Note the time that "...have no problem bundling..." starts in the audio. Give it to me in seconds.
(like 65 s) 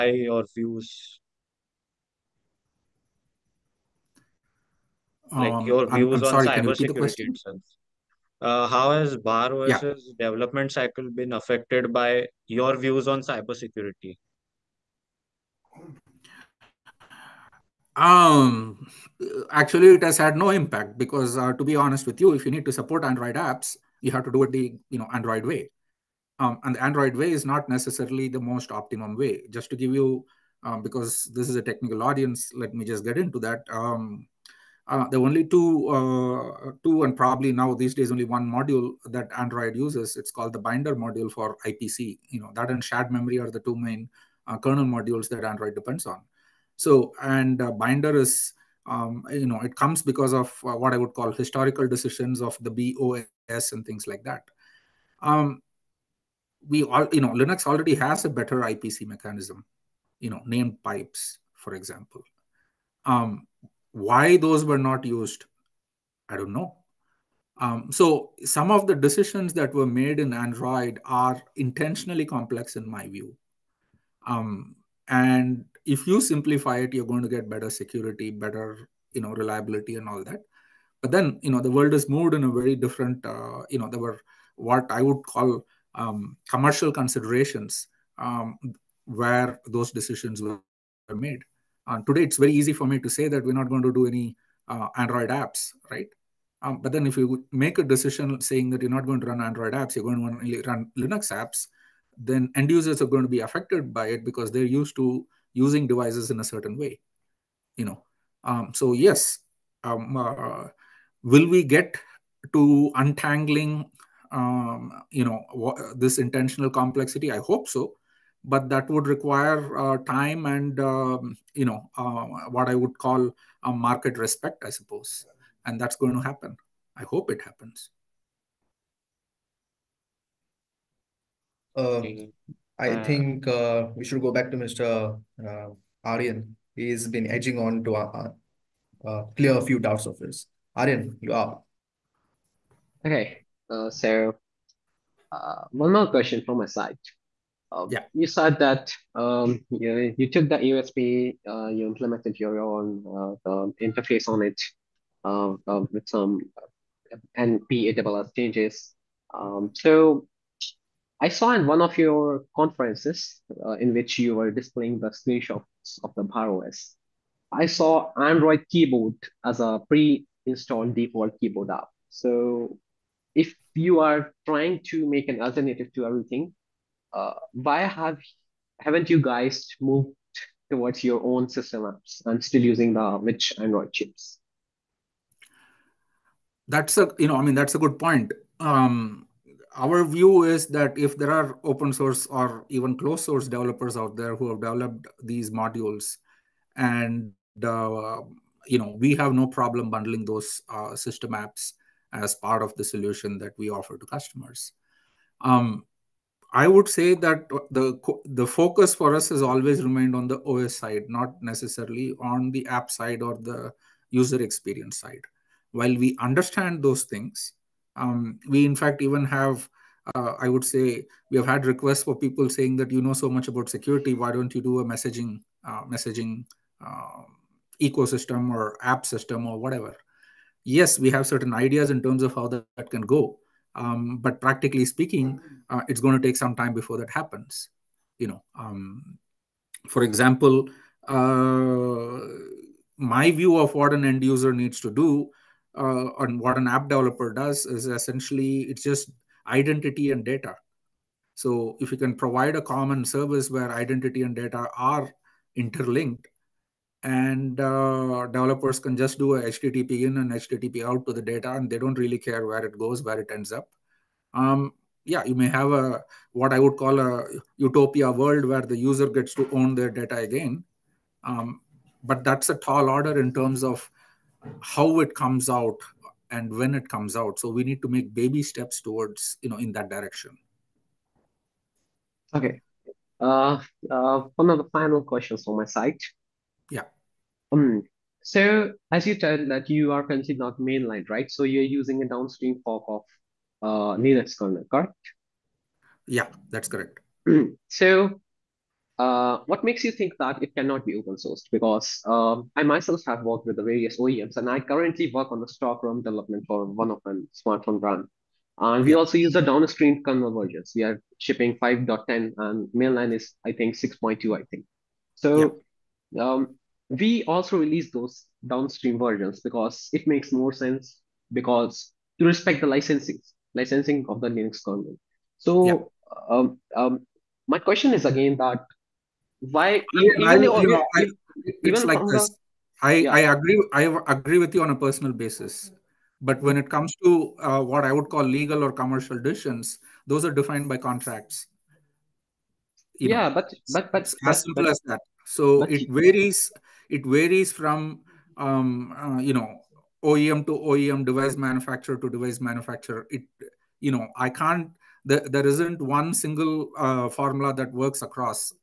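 199 s.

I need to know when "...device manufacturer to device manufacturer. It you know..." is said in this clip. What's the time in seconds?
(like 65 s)
351 s.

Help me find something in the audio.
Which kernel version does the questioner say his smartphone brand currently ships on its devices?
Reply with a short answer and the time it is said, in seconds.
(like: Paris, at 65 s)
5.10, at 311 s.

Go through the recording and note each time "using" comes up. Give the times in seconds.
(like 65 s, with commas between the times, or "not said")
105 s, 182 s, 291 s.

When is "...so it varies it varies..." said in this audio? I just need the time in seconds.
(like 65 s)
345 s.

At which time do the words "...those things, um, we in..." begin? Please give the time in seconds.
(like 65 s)
216 s.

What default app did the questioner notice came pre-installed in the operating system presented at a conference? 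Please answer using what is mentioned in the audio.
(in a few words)
Android keyboard.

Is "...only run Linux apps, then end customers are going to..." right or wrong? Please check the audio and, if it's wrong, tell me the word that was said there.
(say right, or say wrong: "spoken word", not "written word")
wrong: "users", not "customers".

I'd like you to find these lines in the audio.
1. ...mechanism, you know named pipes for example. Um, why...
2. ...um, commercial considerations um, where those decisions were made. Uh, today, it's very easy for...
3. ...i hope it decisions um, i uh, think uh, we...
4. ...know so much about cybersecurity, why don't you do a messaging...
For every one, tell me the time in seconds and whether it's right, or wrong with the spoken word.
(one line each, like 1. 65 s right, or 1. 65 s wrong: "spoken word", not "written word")
1. 59 s right
2. 85 s right
3. 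126 s wrong: "happens", not "decisions"
4. 223 s wrong: "security", not "cybersecurity".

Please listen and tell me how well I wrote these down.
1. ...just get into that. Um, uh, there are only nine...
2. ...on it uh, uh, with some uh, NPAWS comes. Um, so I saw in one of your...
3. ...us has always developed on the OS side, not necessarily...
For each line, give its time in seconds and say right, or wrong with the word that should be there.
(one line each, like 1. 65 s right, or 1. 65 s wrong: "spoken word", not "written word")
1. 32 s wrong: "two", not "nine"
2. 154 s wrong: "changes", not "comes"
3. 209 s wrong: "remained", not "developed".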